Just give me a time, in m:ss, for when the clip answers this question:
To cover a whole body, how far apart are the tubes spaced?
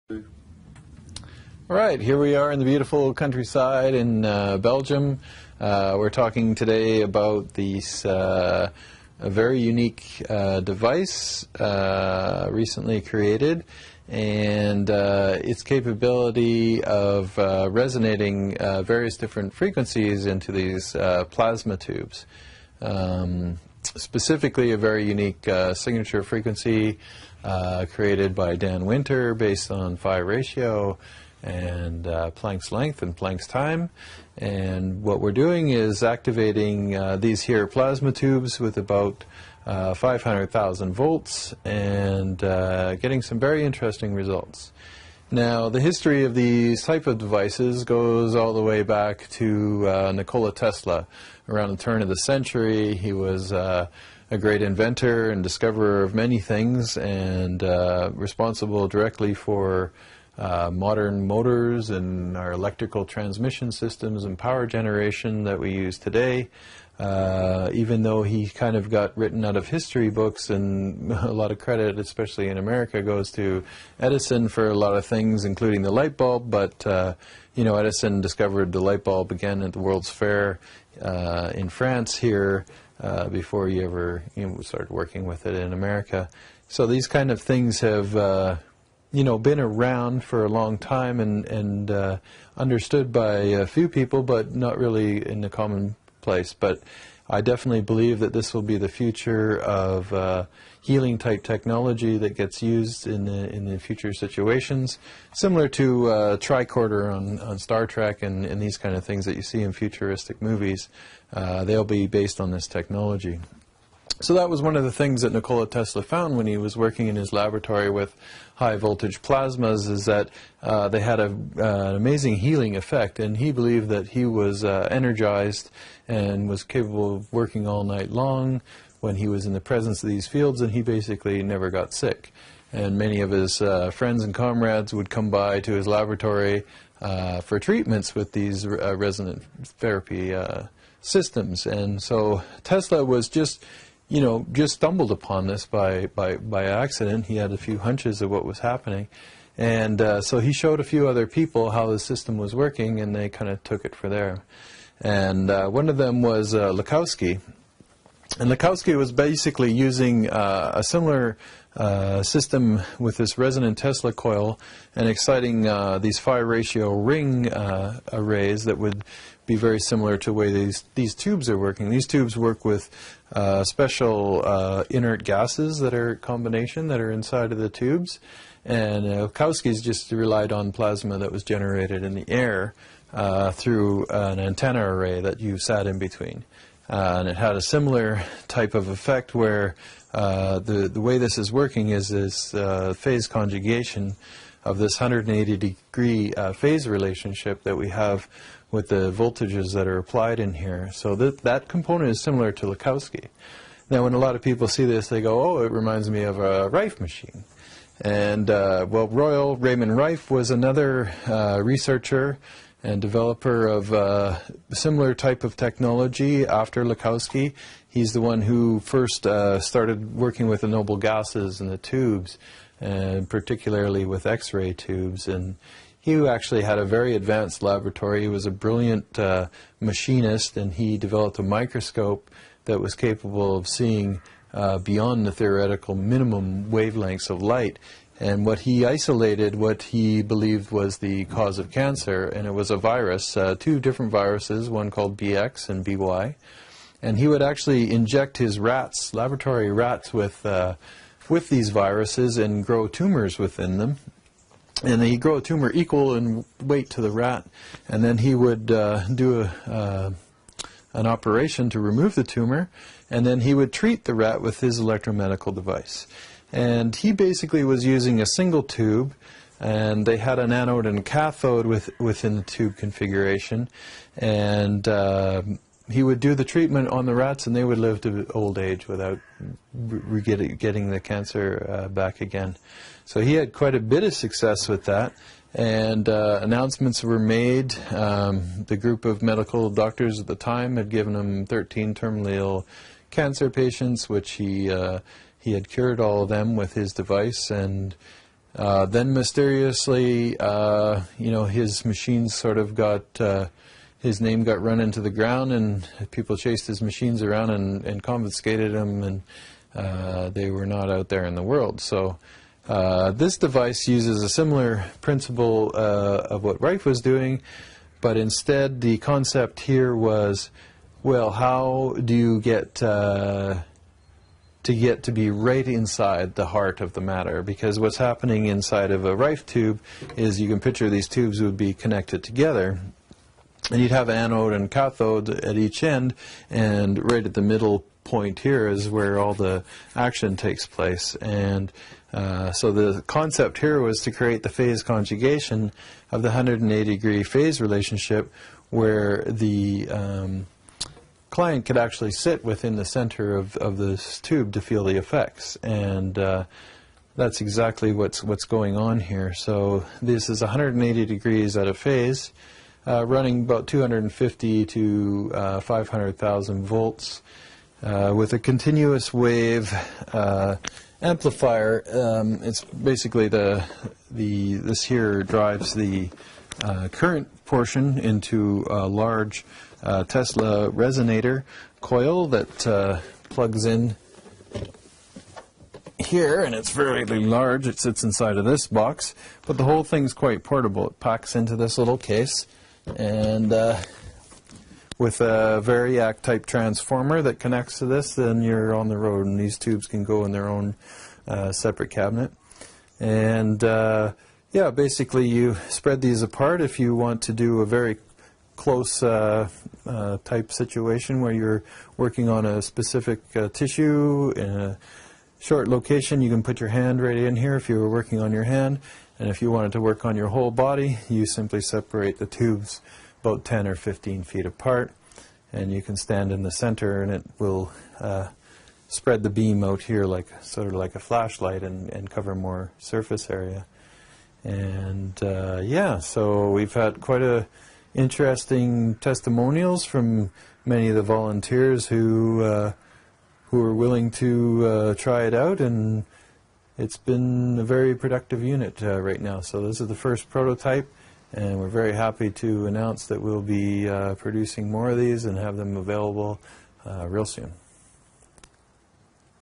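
7:03.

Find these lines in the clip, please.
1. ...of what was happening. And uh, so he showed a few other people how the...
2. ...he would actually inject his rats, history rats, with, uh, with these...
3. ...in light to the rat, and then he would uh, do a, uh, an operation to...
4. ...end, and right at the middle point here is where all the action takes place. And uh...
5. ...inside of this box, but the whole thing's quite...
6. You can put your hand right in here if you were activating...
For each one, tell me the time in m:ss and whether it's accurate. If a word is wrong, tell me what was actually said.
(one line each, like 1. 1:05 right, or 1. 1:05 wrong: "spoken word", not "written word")
1. 2:28 right
2. 4:07 wrong: "laboratory", not "history"
3. 4:16 wrong: "weight", not "light"
4. 5:35 right
5. 6:28 right
6. 6:56 wrong: "working", not "activating".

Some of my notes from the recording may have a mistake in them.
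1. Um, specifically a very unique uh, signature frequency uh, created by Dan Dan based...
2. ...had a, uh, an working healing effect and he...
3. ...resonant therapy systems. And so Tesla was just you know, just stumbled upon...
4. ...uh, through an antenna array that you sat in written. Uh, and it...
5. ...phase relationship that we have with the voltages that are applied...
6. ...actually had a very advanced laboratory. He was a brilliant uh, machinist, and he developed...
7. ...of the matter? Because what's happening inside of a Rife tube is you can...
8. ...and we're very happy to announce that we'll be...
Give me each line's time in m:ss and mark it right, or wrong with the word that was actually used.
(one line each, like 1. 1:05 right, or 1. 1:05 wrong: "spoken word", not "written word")
1. 0:22 wrong: "Winter", not "Dan"
2. 2:00 wrong: "amazing", not "working"
3. 2:18 right
4. 3:03 wrong: "between", not "written"
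5. 3:16 right
6. 3:46 right
7. 5:26 right
8. 7:31 right.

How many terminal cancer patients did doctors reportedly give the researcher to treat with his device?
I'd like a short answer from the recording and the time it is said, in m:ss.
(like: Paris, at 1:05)
13, at 4:51.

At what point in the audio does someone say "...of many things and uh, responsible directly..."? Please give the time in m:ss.
0:56.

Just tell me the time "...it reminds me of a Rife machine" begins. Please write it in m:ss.
3:25.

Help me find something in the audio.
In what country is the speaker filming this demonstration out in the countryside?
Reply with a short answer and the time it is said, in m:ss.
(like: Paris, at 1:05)
Belgium, at 0:04.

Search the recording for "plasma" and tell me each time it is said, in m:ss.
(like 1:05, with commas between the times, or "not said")
0:21, 0:37, 1:59, 3:00.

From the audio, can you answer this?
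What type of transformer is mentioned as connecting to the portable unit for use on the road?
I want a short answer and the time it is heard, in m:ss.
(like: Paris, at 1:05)
variac, at 6:35.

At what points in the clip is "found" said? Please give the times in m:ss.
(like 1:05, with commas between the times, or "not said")
1:56.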